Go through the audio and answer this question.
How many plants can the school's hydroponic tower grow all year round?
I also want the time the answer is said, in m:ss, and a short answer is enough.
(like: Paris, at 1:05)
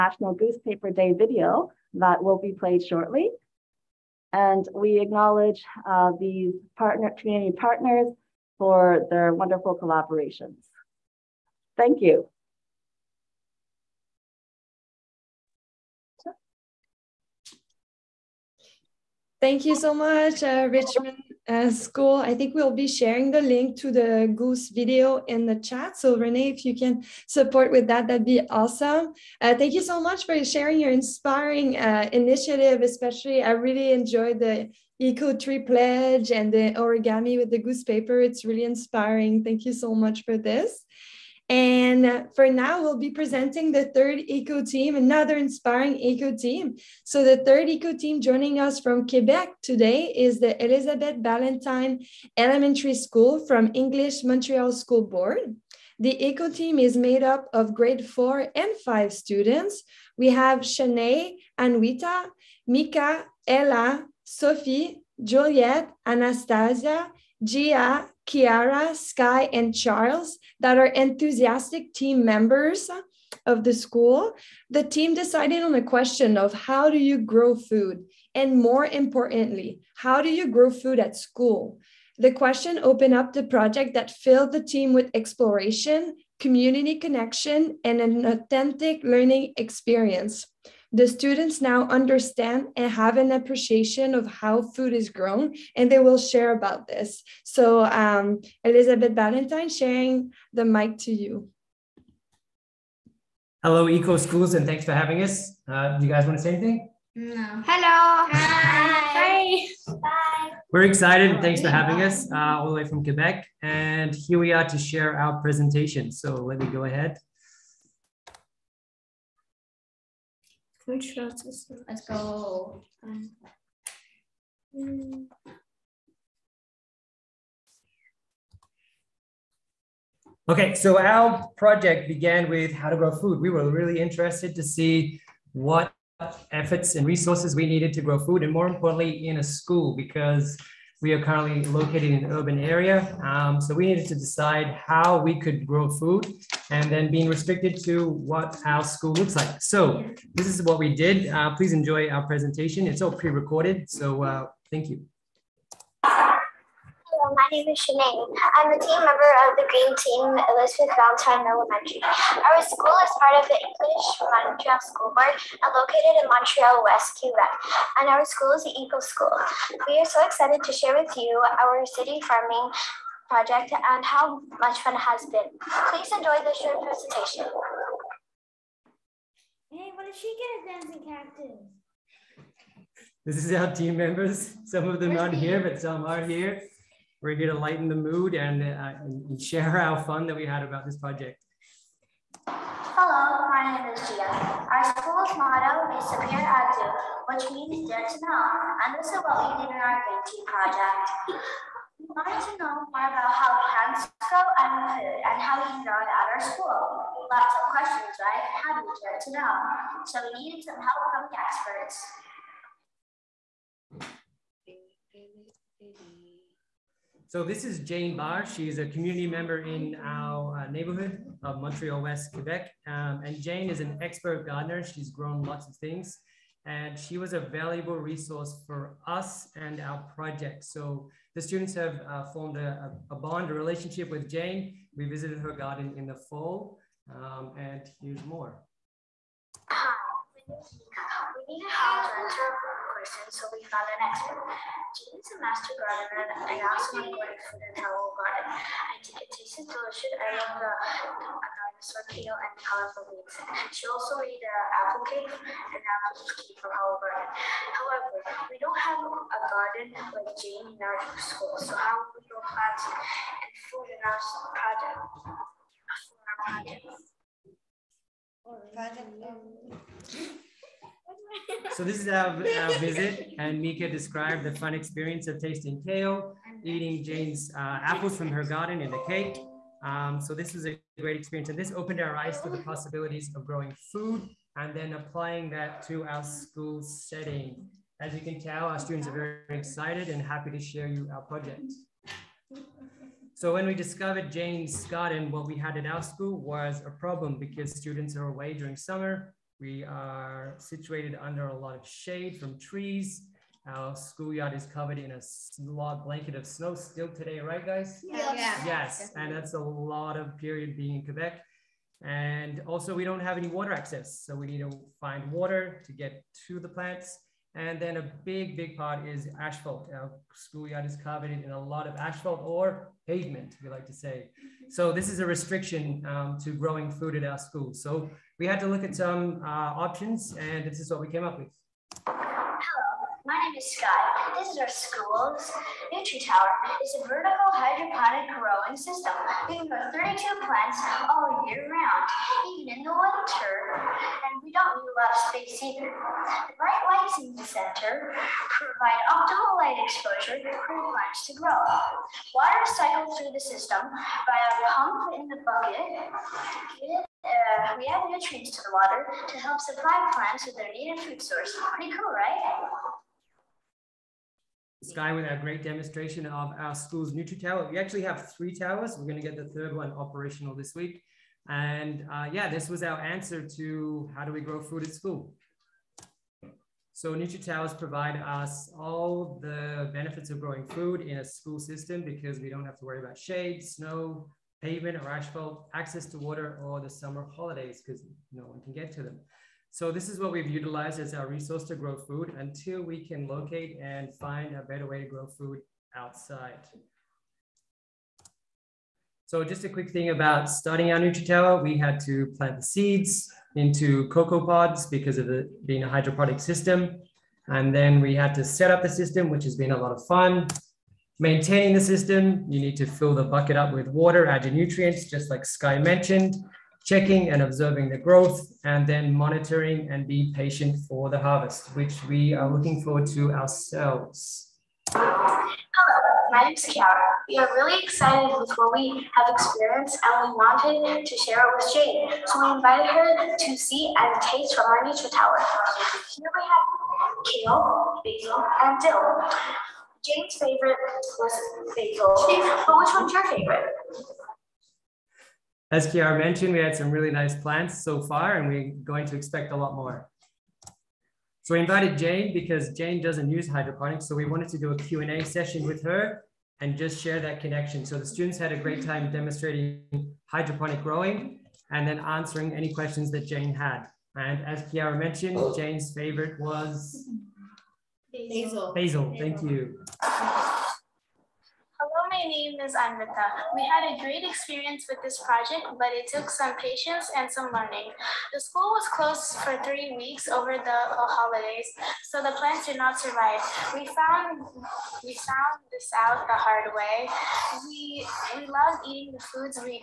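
32, at 5:39.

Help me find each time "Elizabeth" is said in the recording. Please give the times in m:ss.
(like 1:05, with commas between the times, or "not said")
0:50, 1:38, 2:40.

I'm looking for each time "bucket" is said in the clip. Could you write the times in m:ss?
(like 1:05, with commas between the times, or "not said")
5:55, 6:53.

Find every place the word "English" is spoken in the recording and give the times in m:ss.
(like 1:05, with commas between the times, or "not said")
0:53, 2:43.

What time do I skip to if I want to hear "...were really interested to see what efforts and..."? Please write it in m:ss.
2:13.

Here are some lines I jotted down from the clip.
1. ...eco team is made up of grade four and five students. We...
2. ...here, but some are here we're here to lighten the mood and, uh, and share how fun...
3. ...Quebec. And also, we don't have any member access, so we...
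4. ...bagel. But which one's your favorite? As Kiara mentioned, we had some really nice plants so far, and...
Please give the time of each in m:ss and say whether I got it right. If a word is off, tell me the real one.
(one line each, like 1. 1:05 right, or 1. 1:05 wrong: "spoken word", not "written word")
1. 0:56 right
2. 3:05 right
3. 5:11 wrong: "water", not "member"
4. 7:21 right.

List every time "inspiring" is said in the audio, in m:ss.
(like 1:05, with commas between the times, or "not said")
0:30, 0:38, 0:45.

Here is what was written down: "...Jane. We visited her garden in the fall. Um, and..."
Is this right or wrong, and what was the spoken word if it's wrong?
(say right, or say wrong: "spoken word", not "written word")
right.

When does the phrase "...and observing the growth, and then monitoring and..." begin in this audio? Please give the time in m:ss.
6:57.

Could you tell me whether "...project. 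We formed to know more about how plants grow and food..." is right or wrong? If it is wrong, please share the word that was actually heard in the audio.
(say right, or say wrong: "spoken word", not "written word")
wrong: "wanted", not "formed".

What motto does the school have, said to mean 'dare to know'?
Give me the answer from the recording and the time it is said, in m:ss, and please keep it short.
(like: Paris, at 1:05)
Sabir Active, at 3:16.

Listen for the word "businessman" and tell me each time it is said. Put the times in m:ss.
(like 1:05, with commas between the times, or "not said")
not said.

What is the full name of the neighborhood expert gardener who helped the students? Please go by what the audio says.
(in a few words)
Jane Barr.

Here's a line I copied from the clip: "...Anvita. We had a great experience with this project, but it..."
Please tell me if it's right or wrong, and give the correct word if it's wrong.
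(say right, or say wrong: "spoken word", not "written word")
right.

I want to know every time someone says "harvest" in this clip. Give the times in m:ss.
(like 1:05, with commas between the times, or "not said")
7:01.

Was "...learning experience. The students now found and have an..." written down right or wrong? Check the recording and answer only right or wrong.
wrong.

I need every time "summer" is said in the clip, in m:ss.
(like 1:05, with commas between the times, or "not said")
4:58, 6:26.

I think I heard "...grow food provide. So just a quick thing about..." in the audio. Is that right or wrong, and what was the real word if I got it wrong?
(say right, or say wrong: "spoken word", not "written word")
wrong: "outside", not "provide".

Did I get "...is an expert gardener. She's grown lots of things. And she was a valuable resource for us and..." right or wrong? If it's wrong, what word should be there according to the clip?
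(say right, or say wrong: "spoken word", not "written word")
right.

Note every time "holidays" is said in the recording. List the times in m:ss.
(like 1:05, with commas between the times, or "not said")
6:27, 8:00.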